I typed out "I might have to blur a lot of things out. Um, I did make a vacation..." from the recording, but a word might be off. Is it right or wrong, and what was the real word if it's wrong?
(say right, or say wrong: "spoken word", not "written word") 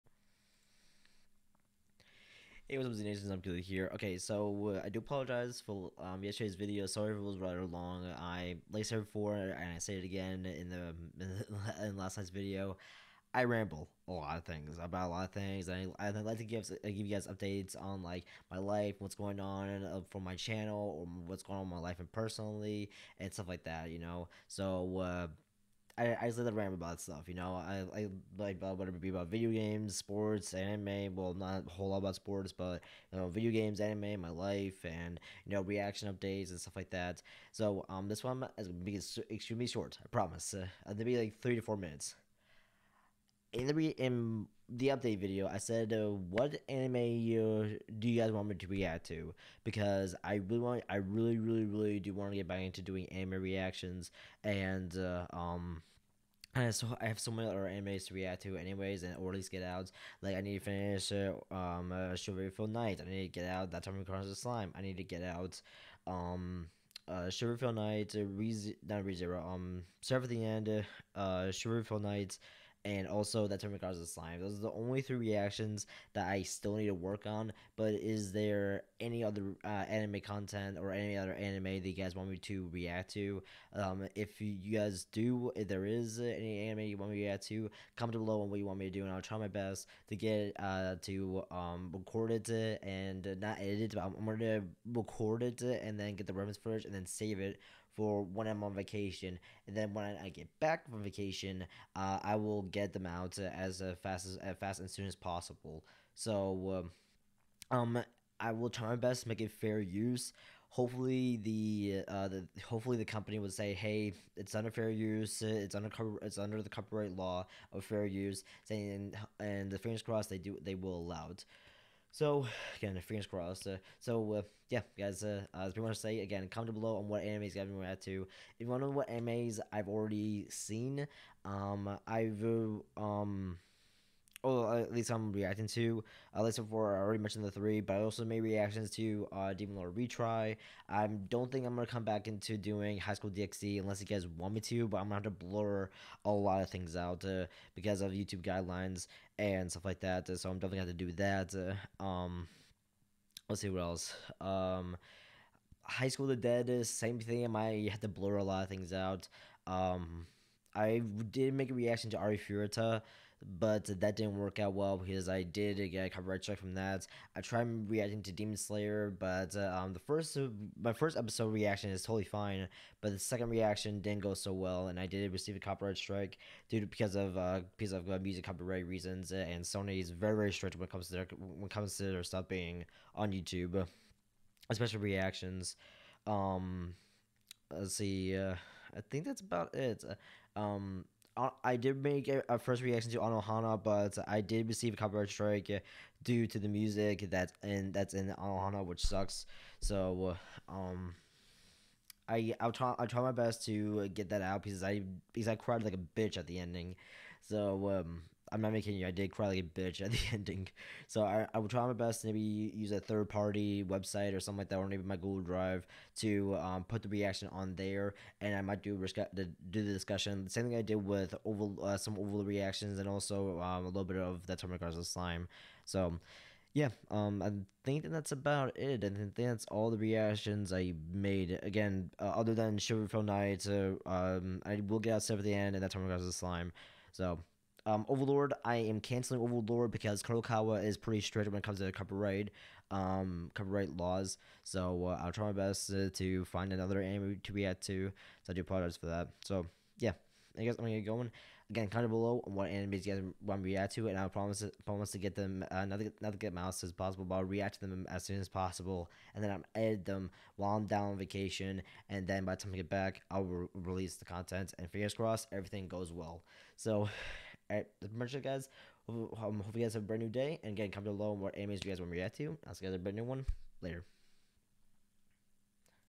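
wrong: "reaction", not "vacation".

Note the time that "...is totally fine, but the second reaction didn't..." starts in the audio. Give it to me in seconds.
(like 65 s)
171 s.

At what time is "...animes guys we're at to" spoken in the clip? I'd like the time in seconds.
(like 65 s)
127 s.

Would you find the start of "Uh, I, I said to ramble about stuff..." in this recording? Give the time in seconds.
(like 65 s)
24 s.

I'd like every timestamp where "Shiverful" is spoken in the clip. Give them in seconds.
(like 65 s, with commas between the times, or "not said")
62 s, 67 s, 71 s.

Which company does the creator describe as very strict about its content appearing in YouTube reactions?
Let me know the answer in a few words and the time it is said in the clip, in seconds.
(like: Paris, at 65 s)
Sony, at 179 s.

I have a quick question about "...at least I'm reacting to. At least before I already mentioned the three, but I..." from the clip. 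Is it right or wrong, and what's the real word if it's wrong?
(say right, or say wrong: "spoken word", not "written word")
right.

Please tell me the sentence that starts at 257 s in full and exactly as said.
But I'll react to them as soon as possible, and then I'll edit them while I'm down on vacation.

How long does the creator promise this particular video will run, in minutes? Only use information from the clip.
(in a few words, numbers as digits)
3 to 4 minutes.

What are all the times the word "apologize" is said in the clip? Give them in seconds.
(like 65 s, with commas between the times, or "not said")
4 s, 248 s.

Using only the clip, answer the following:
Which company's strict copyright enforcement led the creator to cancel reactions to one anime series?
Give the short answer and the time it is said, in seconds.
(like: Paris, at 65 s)
Kadokawa, at 240 s.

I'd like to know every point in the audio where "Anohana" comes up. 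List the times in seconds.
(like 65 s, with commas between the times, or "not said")
193 s, 198 s.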